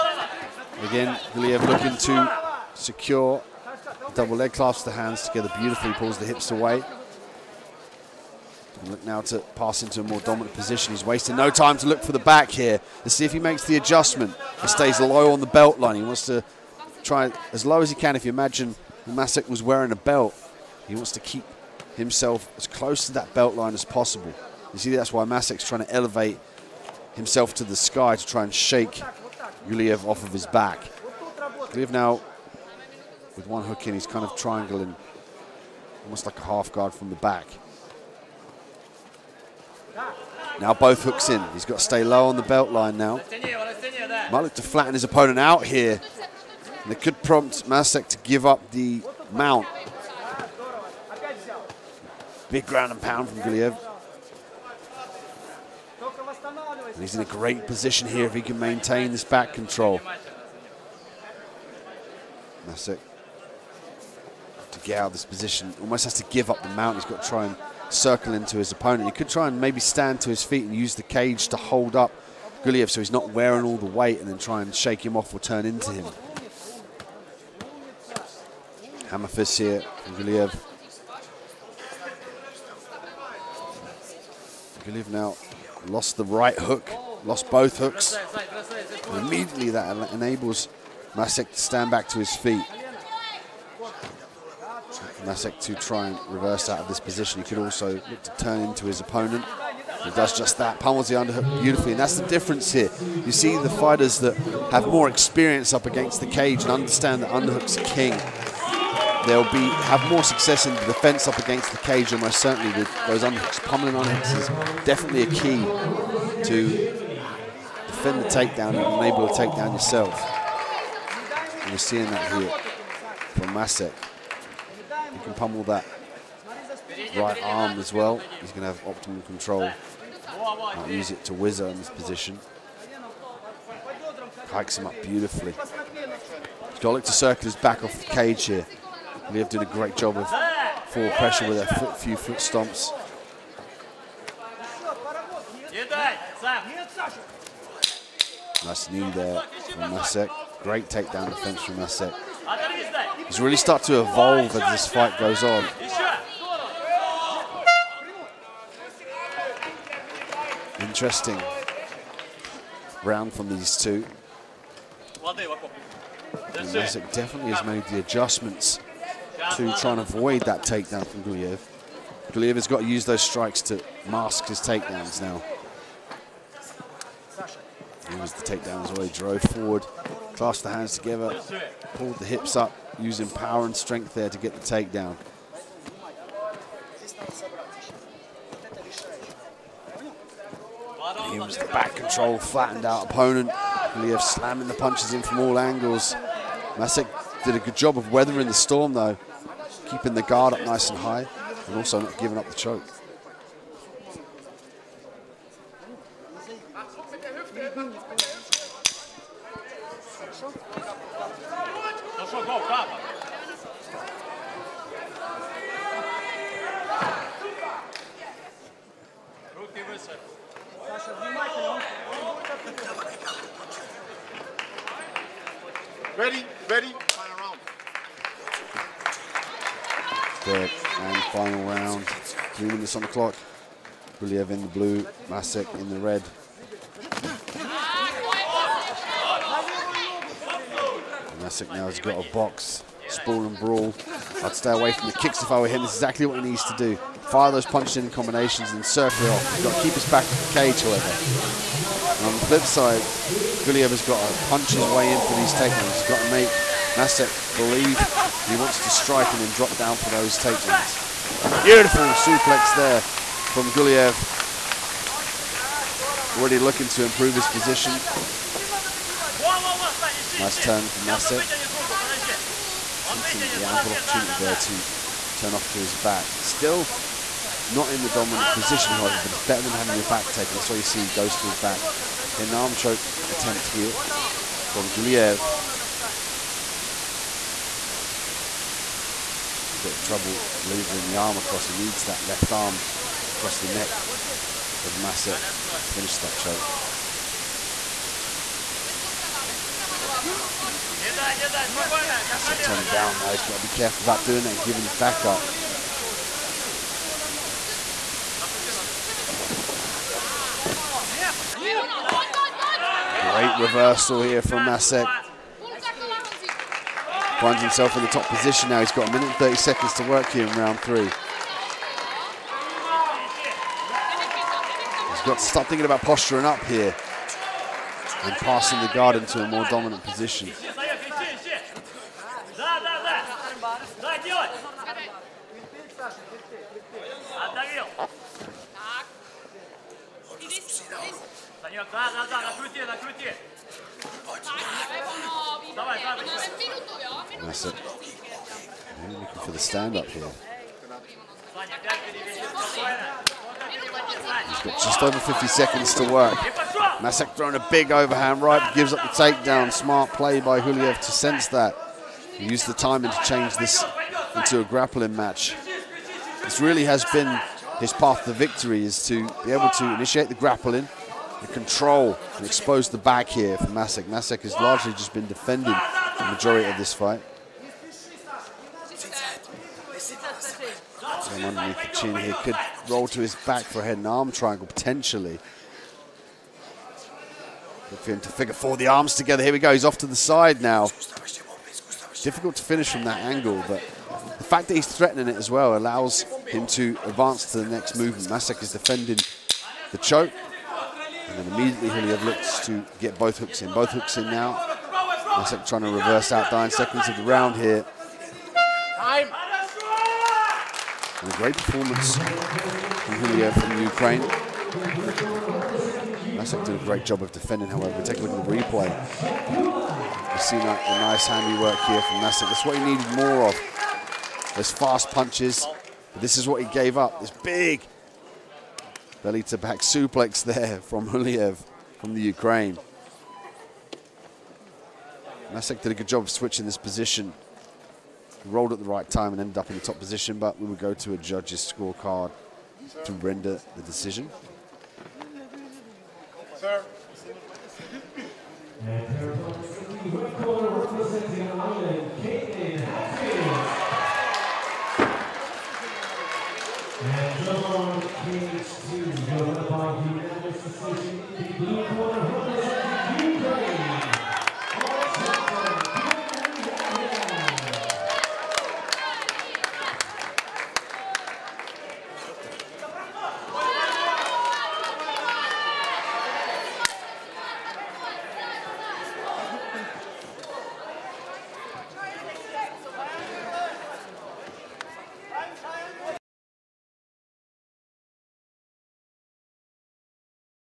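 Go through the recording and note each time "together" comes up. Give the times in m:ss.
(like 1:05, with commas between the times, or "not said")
0:05, 3:00, 6:29.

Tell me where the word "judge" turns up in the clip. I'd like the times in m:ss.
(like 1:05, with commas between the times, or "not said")
7:21.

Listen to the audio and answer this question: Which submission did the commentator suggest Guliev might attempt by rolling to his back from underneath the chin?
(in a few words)
Head and arm triangle.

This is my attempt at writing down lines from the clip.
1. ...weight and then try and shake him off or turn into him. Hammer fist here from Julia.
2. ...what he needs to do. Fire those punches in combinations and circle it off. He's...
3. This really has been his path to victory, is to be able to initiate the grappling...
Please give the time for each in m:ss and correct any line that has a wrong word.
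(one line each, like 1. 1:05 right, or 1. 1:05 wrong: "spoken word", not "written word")
1. 1:13 wrong: "Guliev", not "Julia"
2. 4:06 right
3. 6:06 right.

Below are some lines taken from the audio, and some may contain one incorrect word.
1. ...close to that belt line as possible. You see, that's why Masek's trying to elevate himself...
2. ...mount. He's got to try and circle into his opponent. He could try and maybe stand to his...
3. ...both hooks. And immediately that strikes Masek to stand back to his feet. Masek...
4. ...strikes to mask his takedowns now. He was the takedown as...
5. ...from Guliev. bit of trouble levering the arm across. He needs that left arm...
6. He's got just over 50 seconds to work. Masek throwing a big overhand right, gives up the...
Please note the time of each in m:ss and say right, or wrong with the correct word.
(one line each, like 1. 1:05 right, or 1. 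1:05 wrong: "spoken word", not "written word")
1. 0:22 right
2. 1:06 right
3. 1:27 wrong: "enables", not "strikes"
4. 2:53 right
5. 4:44 right
6. 5:54 right.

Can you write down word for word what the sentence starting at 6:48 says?
Time a great performance from Julia from Ukraine.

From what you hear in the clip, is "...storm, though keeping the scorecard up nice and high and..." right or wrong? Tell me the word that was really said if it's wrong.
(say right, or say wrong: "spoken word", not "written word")
wrong: "guard", not "scorecard".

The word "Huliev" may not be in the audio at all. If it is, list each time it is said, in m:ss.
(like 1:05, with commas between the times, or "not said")
6:00, 6:41, 7:11.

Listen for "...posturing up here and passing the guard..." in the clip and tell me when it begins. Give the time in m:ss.
5:26.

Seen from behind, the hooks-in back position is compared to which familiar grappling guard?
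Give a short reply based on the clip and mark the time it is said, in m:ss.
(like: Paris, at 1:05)
Half guard, at 0:36.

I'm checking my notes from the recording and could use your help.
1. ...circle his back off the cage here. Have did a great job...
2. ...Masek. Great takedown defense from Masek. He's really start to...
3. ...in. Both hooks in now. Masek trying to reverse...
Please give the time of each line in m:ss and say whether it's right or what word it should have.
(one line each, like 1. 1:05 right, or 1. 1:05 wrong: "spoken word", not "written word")
1. 2:17 right
2. 2:29 right
3. 6:43 right.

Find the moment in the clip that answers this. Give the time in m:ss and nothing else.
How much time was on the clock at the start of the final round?
3:52.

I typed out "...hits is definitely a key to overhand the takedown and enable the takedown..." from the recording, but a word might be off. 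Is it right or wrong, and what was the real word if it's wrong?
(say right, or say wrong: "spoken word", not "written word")
wrong: "defend", not "overhand".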